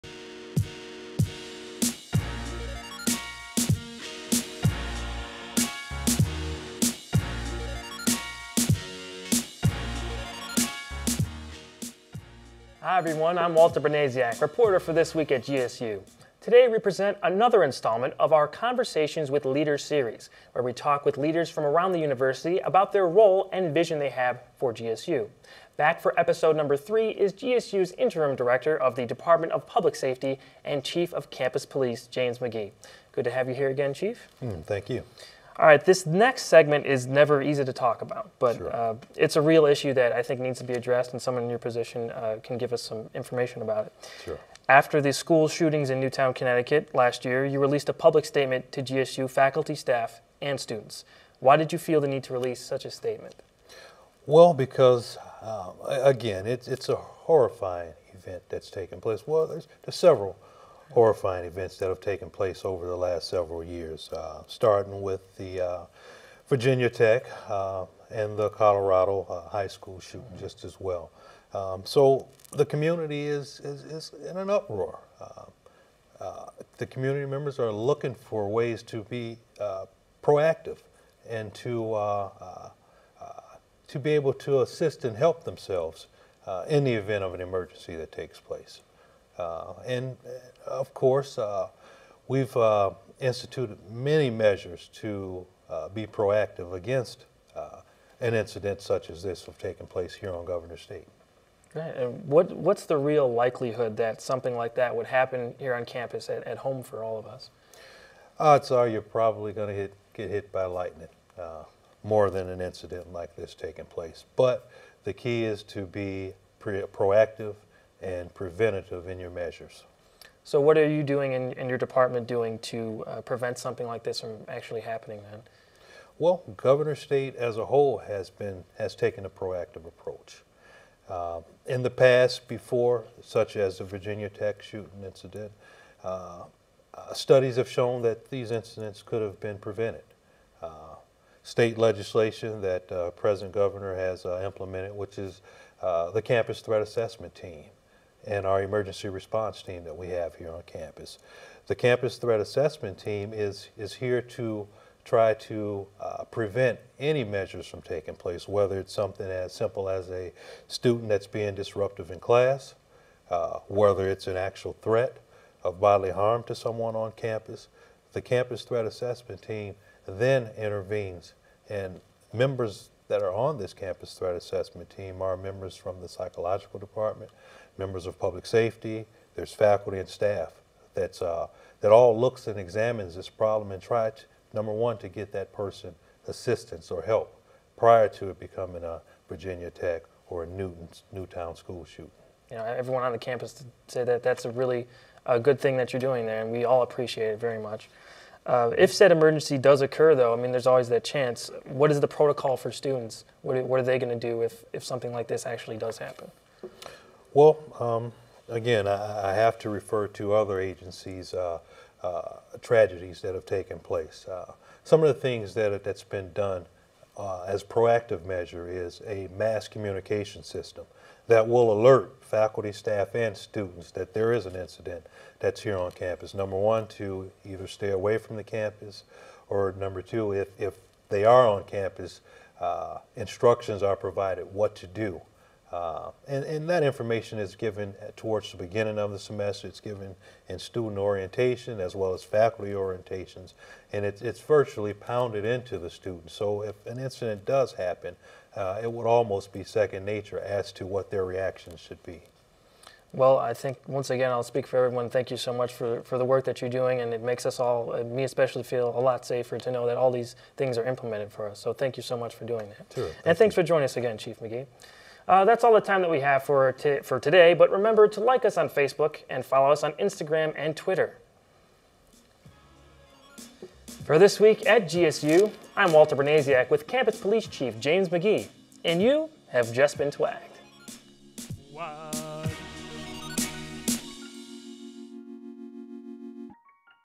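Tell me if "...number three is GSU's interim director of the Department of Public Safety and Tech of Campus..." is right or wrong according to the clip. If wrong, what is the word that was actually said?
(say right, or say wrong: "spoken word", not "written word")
wrong: "Chief", not "Tech".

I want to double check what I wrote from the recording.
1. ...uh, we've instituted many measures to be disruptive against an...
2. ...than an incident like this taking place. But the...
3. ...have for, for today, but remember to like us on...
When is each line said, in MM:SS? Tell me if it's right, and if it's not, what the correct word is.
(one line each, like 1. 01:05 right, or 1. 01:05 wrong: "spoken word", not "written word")
1. 01:31 wrong: "proactive", not "disruptive"
2. 01:52 right
3. 04:26 right.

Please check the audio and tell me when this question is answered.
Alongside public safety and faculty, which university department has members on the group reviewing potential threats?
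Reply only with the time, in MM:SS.
02:56.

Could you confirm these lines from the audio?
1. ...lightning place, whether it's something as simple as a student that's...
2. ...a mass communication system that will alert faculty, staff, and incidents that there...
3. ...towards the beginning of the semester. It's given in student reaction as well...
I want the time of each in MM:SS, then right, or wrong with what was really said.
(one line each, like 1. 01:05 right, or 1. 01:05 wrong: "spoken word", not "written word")
1. 02:37 wrong: "taking", not "lightning"
2. 03:39 wrong: "students", not "incidents"
3. 03:58 wrong: "orientation", not "reaction".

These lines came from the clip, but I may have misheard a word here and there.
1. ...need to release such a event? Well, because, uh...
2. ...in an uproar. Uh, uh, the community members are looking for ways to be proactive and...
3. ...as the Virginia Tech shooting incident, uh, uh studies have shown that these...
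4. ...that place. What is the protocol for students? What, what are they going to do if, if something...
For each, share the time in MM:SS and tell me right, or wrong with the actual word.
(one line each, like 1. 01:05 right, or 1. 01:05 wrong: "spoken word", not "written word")
1. 00:52 wrong: "statement", not "event"
2. 01:14 right
3. 02:13 right
4. 03:20 wrong: "chance", not "place".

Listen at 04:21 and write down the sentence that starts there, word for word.
So thank you so much for doing that.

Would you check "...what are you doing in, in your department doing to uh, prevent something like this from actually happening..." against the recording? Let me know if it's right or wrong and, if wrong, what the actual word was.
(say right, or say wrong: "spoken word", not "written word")
right.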